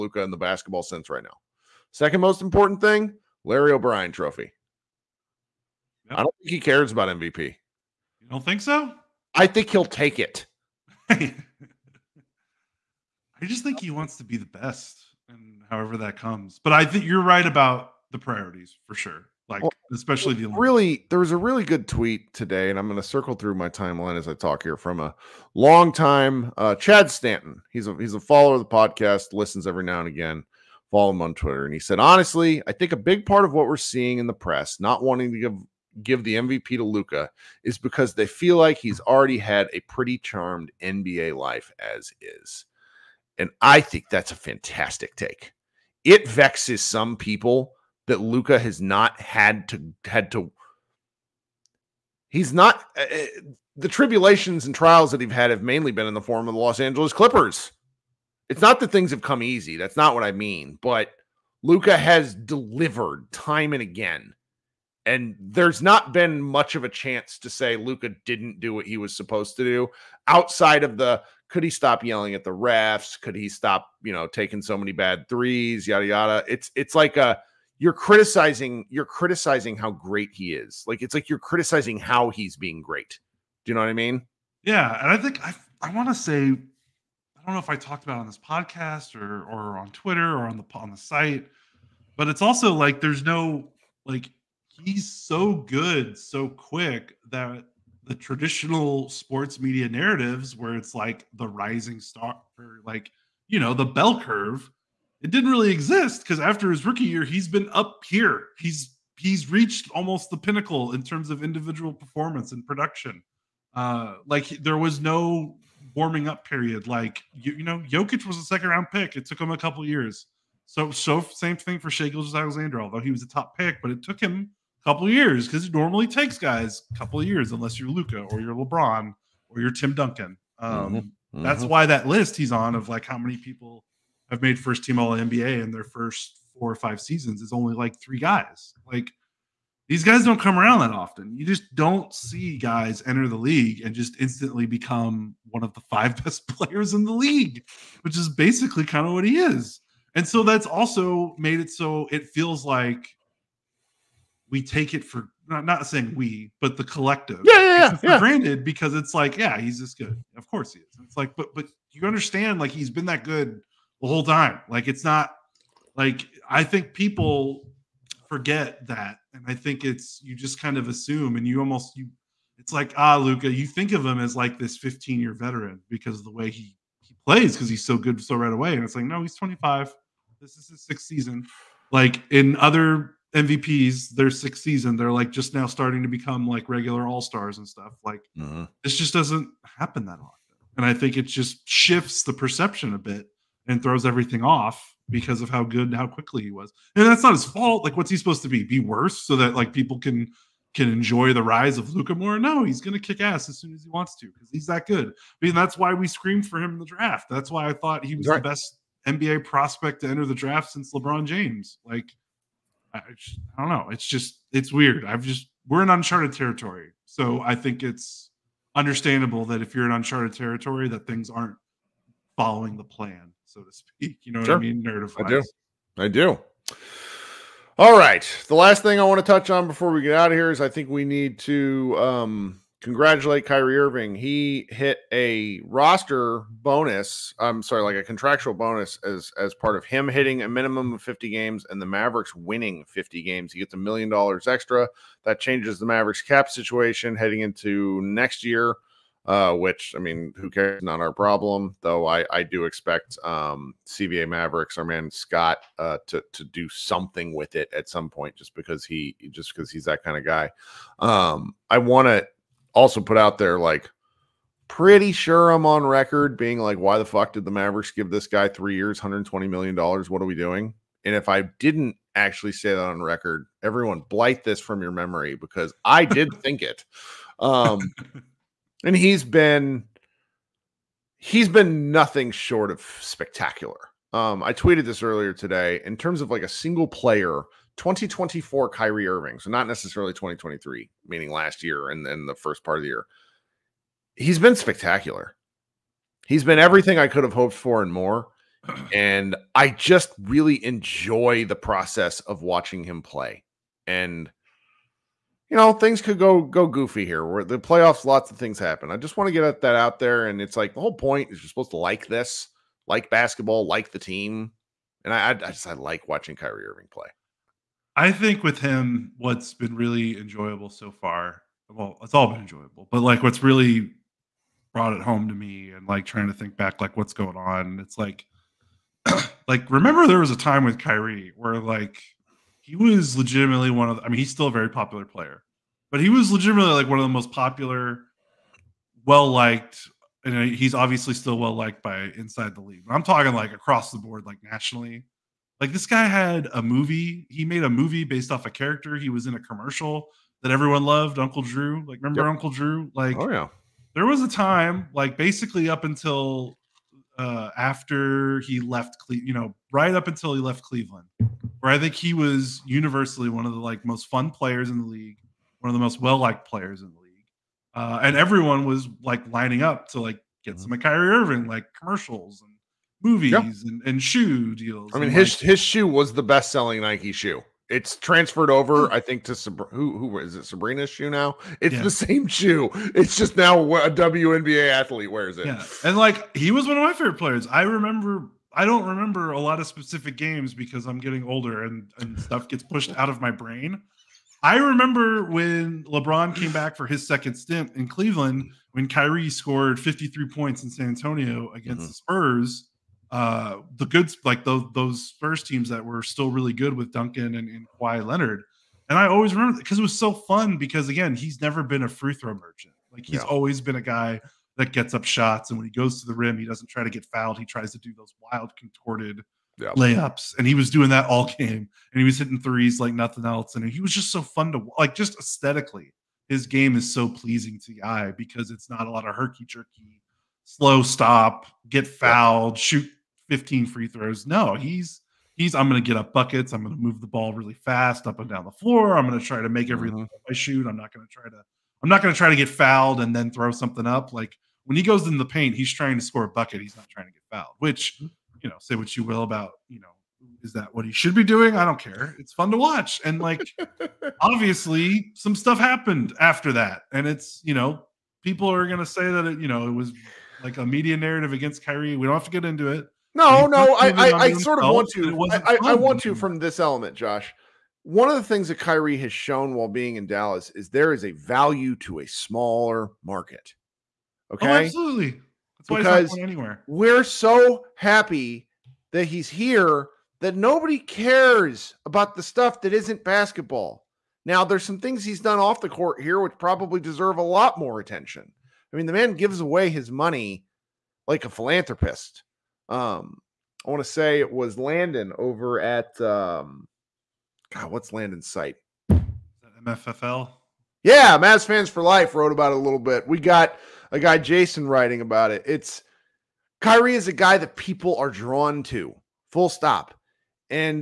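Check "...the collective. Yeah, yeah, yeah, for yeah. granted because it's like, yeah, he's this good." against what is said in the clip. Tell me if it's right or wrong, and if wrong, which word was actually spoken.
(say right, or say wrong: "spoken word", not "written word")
right.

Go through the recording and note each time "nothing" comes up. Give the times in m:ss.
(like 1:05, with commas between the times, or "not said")
4:41, 7:02.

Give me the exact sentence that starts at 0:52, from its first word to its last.
He's not uh, the tribulations and trials that he's had have mainly been in the form of the Los Angeles Clippers.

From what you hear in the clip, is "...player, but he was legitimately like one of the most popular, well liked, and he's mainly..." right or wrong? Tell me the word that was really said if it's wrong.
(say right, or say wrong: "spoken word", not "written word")
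wrong: "obviously", not "mainly".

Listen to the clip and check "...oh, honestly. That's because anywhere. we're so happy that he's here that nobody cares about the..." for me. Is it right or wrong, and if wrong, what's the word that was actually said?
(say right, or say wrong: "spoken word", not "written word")
wrong: "absolutely", not "honestly".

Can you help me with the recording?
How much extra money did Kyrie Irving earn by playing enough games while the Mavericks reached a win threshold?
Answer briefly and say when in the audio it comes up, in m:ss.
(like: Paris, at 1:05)
a million dollars, at 4:03.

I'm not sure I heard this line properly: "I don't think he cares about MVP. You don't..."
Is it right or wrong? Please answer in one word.
right.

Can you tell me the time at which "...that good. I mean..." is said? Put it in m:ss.
3:24.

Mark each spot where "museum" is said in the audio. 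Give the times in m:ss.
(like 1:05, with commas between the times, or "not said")
not said.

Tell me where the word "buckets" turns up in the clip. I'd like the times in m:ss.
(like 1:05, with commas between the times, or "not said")
7:16, 7:26.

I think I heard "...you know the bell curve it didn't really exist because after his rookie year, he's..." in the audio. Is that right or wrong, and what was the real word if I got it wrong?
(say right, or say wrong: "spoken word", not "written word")
right.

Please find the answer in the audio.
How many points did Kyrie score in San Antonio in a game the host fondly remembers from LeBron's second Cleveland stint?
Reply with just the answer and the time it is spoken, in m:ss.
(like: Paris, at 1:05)
53, at 6:39.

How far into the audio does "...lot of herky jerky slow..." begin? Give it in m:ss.
7:08.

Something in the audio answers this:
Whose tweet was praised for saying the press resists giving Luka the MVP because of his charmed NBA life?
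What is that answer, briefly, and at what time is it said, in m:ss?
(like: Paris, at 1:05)
Chad Stanton, at 0:26.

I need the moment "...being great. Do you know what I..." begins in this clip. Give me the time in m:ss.
1:22.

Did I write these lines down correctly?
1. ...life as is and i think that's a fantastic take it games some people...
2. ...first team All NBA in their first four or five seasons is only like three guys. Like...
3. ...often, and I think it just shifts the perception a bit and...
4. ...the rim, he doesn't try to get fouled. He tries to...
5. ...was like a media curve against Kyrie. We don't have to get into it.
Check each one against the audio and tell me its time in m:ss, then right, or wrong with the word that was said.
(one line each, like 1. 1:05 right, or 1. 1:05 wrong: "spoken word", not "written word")
1. 0:41 wrong: "vexes", not "games"
2. 2:14 right
3. 3:10 right
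4. 6:56 right
5. 7:39 wrong: "narrative", not "curve".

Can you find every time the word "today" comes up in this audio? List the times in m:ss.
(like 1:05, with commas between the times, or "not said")
0:22, 4:45.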